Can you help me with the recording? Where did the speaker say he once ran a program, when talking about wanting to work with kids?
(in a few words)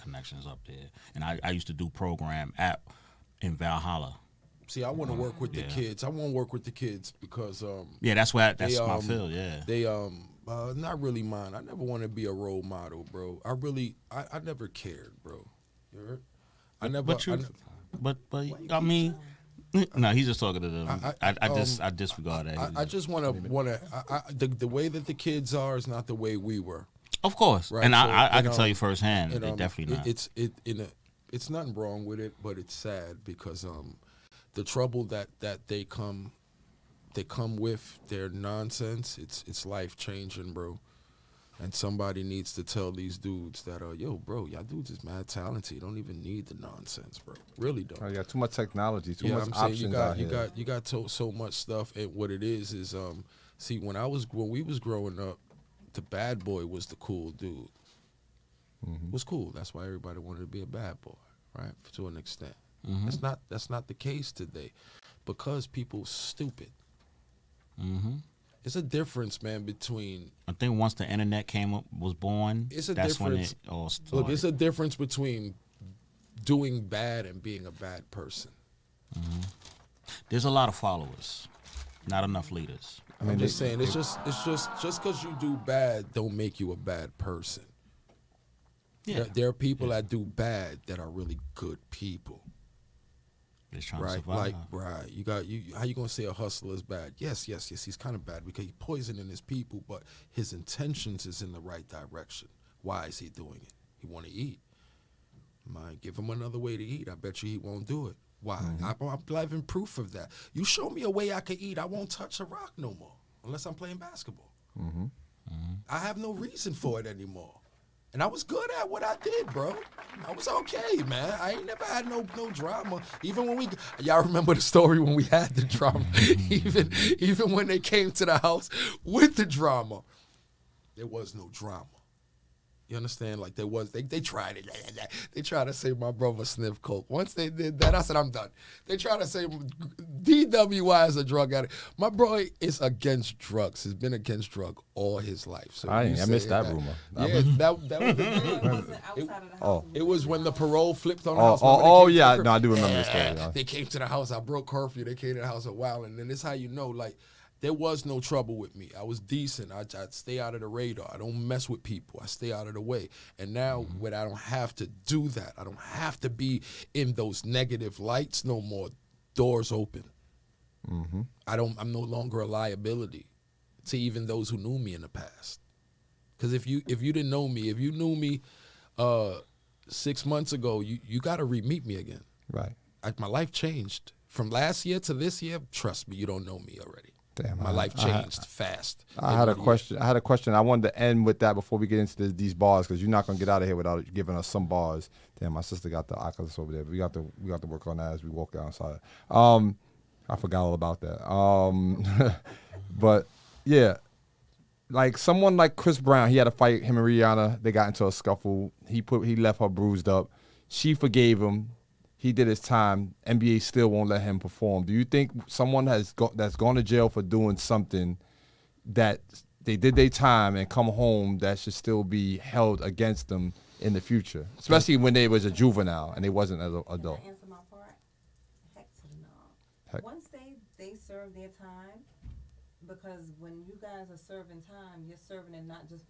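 Valhalla.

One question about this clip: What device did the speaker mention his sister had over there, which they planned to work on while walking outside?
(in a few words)
Oculus.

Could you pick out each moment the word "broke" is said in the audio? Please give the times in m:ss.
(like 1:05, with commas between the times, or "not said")
2:34.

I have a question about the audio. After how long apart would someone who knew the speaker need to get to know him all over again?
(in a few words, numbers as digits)
6 months.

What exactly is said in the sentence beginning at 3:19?
Um, I forgot all about that.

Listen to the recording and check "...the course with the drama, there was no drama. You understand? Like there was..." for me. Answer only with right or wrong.
wrong.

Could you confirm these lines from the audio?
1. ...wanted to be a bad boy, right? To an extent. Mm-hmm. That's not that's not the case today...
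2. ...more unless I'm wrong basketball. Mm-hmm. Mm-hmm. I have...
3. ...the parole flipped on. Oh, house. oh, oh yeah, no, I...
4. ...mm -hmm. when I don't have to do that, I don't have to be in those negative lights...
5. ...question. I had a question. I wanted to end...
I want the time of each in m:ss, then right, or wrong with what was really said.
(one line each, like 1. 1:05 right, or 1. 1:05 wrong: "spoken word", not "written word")
1. 1:00 right
2. 1:52 wrong: "playing", not "wrong"
3. 2:30 right
4. 2:43 right
5. 3:09 right.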